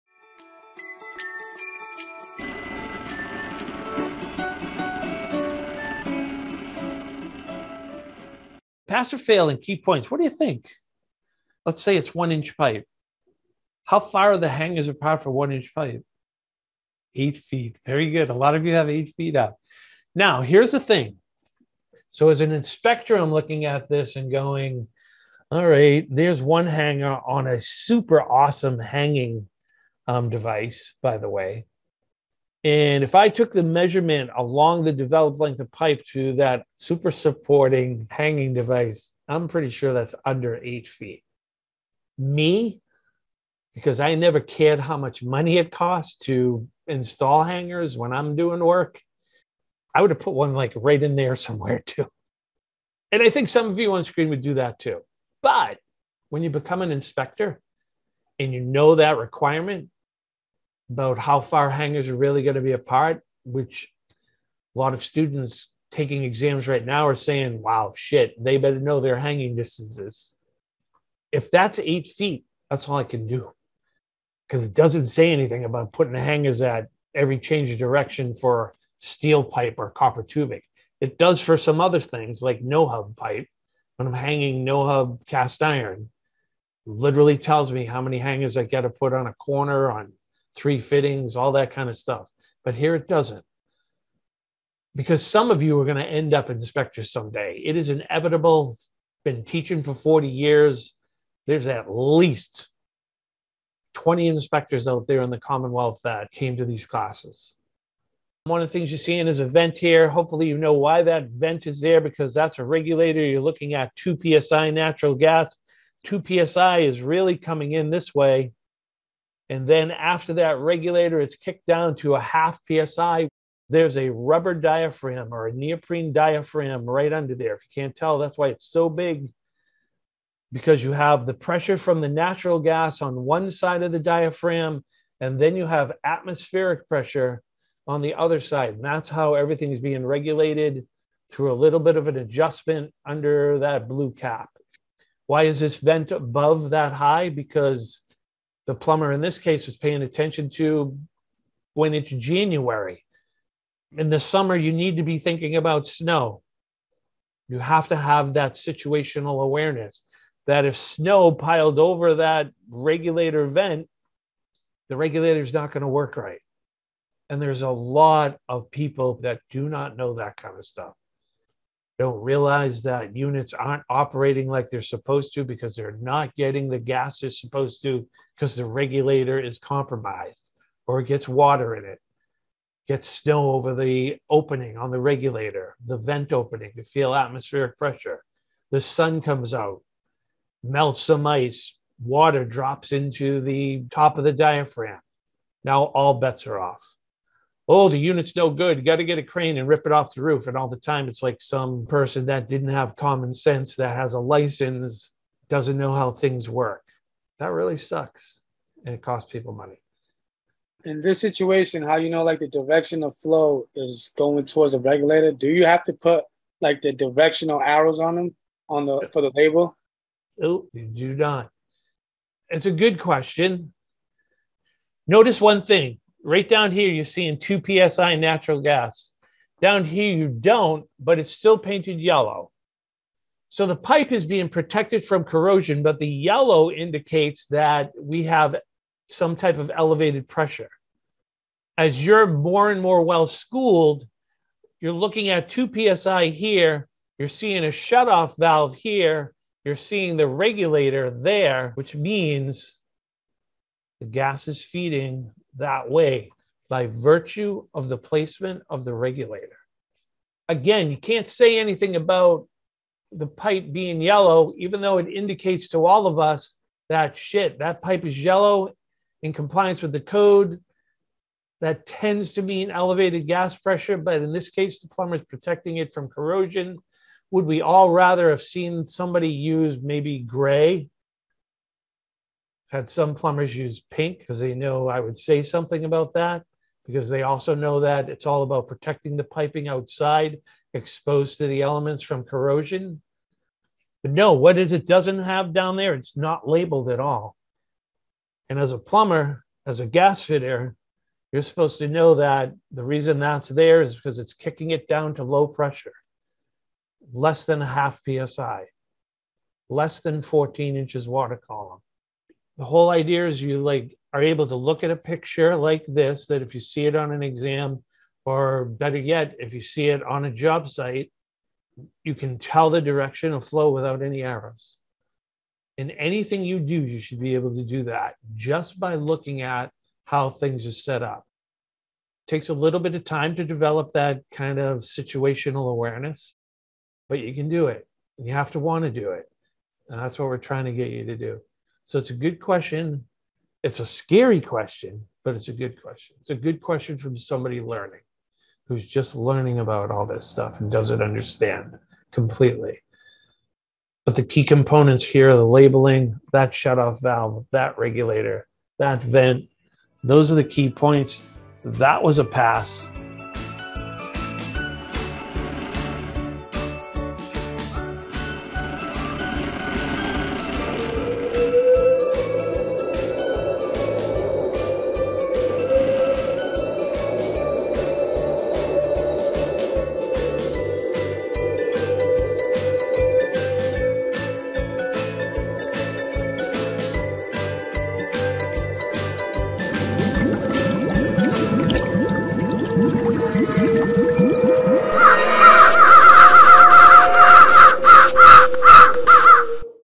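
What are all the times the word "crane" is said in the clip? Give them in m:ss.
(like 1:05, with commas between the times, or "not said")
3:19.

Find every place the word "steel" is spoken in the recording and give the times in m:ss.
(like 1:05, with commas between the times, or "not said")
1:18.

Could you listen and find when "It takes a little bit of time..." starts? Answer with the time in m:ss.
5:32.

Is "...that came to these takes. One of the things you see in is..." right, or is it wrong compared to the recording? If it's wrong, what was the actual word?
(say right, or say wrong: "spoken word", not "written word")
wrong: "classes", not "takes".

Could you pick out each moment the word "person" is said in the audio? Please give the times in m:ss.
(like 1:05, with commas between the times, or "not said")
3:21.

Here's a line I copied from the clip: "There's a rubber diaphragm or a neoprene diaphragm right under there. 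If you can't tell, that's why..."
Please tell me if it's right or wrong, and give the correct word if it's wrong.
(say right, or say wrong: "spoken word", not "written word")
right.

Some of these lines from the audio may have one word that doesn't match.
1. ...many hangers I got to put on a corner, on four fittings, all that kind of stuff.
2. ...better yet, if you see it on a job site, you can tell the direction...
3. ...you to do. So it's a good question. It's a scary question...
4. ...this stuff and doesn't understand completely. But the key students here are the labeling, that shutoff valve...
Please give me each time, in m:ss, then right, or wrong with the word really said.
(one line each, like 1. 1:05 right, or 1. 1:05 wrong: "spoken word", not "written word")
1. 1:28 wrong: "three", not "four"
2. 5:18 right
3. 5:40 right
4. 5:50 wrong: "components", not "students".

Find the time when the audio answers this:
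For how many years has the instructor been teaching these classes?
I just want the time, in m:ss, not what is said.
1:39.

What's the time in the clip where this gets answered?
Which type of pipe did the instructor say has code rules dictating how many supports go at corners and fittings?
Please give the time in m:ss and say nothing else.
1:24.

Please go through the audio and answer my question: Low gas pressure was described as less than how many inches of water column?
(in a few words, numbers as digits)
14.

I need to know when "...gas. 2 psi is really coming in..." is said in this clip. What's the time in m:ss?
1:55.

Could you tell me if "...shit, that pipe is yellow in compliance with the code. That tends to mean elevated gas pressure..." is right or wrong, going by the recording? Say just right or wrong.
right.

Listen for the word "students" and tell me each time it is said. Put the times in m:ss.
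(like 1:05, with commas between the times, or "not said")
1:05.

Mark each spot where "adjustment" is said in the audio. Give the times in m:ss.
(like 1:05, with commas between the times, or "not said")
2:22.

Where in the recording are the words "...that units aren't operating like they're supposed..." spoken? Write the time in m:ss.
2:52.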